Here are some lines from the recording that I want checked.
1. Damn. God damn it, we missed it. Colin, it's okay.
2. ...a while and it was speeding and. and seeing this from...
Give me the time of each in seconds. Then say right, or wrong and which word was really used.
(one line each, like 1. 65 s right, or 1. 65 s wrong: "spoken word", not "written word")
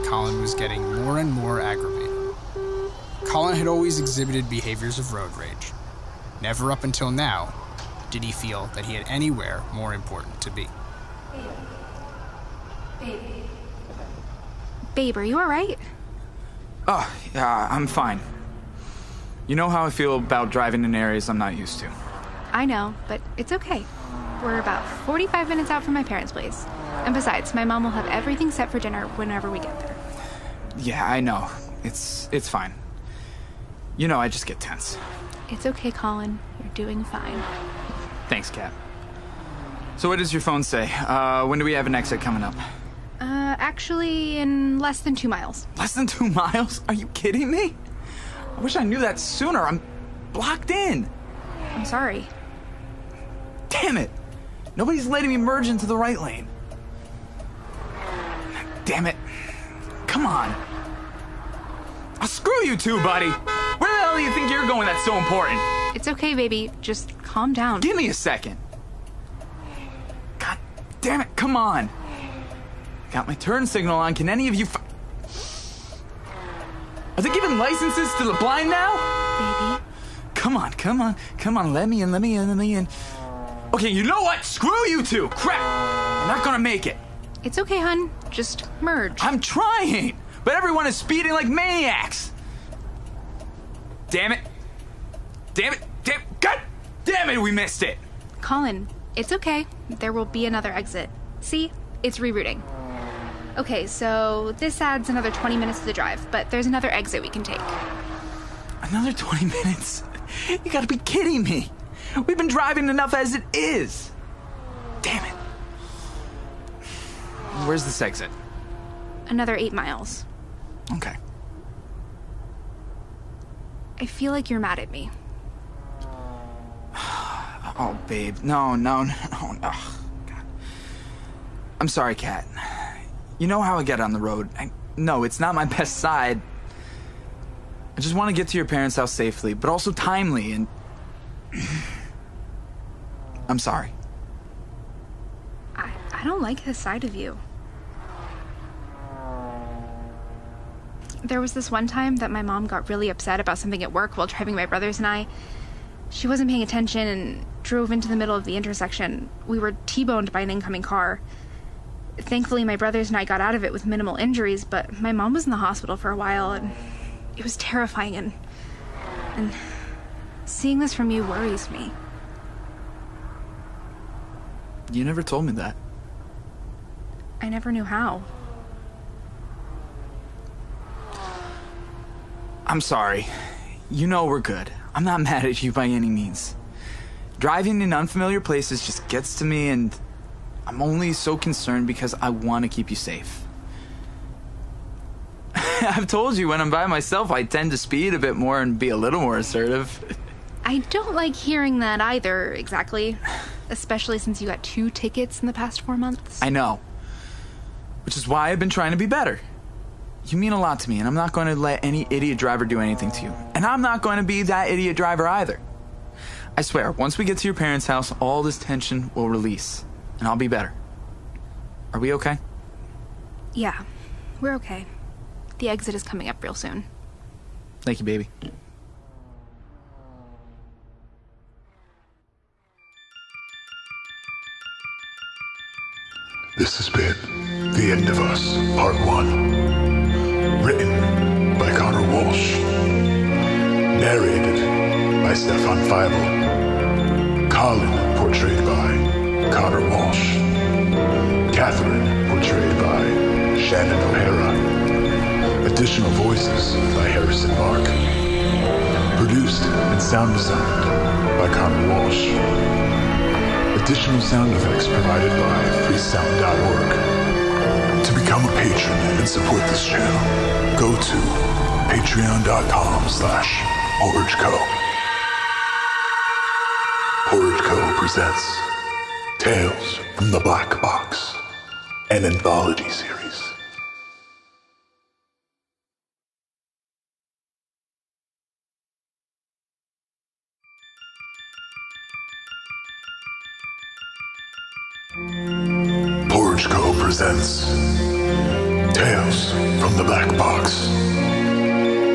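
1. 96 s right
2. 166 s wrong: "terrifying", not "speeding".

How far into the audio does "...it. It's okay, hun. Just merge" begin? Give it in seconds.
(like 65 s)
86 s.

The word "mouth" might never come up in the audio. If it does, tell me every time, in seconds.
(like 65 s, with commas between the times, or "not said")
not said.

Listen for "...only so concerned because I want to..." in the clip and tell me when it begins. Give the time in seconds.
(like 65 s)
190 s.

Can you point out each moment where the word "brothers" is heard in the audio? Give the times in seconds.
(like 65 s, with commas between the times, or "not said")
154 s, 162 s.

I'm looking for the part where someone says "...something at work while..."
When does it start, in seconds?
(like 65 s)
153 s.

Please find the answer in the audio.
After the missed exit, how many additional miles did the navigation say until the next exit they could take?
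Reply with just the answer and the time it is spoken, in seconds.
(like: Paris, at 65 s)
8 miles, at 119 s.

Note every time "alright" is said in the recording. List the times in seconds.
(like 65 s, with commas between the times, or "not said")
15 s.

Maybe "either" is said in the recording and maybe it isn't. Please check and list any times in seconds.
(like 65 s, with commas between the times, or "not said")
202 s, 215 s.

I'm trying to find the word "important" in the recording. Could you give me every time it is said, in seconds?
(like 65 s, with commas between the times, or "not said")
9 s, 65 s.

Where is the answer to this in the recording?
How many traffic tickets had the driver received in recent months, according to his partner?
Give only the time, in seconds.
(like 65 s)
204 s.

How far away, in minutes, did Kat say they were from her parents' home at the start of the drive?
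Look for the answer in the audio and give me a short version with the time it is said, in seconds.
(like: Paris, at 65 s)
45 minutes, at 25 s.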